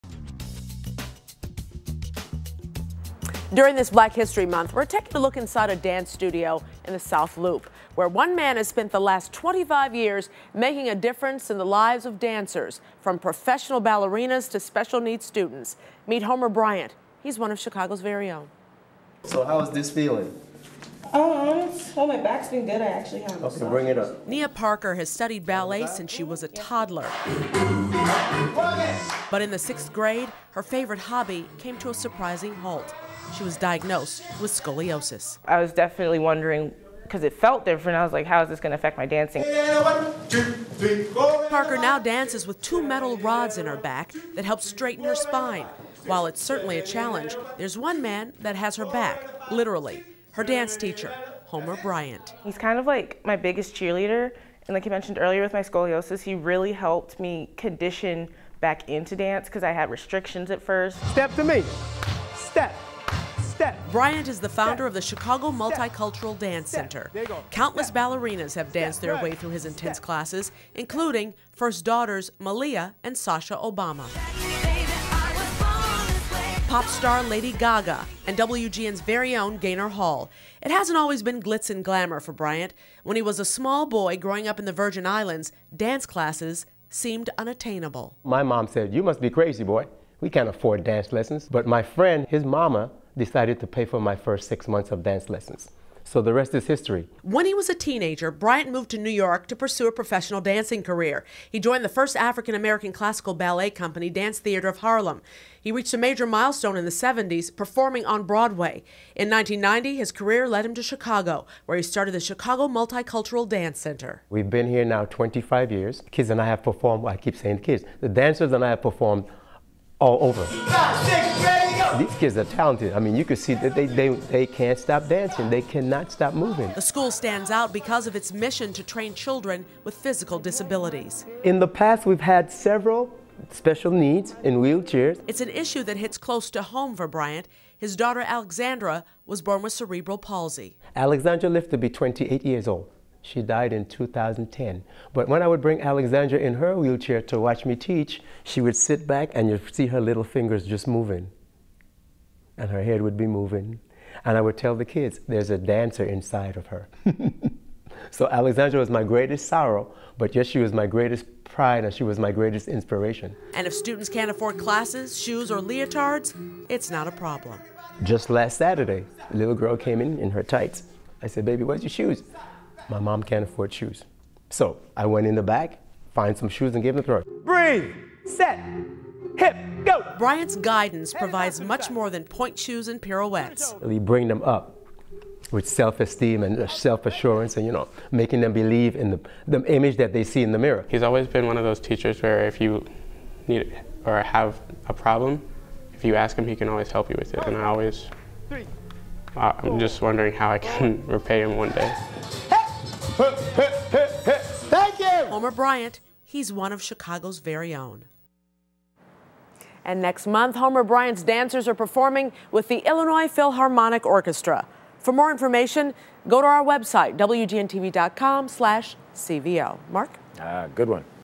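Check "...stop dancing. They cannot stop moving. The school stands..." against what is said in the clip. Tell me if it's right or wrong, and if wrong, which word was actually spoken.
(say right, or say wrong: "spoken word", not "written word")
right.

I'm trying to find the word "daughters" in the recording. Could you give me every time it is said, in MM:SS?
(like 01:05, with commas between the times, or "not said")
01:11, 02:17.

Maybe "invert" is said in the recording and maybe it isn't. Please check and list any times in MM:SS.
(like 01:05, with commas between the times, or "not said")
not said.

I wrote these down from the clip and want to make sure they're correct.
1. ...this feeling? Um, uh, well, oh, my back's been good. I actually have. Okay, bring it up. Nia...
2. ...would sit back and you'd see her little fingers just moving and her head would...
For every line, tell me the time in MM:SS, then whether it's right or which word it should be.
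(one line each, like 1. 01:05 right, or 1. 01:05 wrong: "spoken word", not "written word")
1. 00:19 right
2. 02:28 right.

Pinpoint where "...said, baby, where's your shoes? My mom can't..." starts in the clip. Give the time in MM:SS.
02:51.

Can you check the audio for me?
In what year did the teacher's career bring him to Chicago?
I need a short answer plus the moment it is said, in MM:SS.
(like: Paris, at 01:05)
1990, at 01:49.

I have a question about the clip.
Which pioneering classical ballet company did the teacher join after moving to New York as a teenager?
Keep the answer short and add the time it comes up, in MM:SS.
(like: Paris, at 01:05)
Dance Theater of Harlem, at 01:44.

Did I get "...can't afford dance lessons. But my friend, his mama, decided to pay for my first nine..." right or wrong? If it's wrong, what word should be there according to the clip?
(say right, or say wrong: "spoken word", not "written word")
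wrong: "six", not "nine".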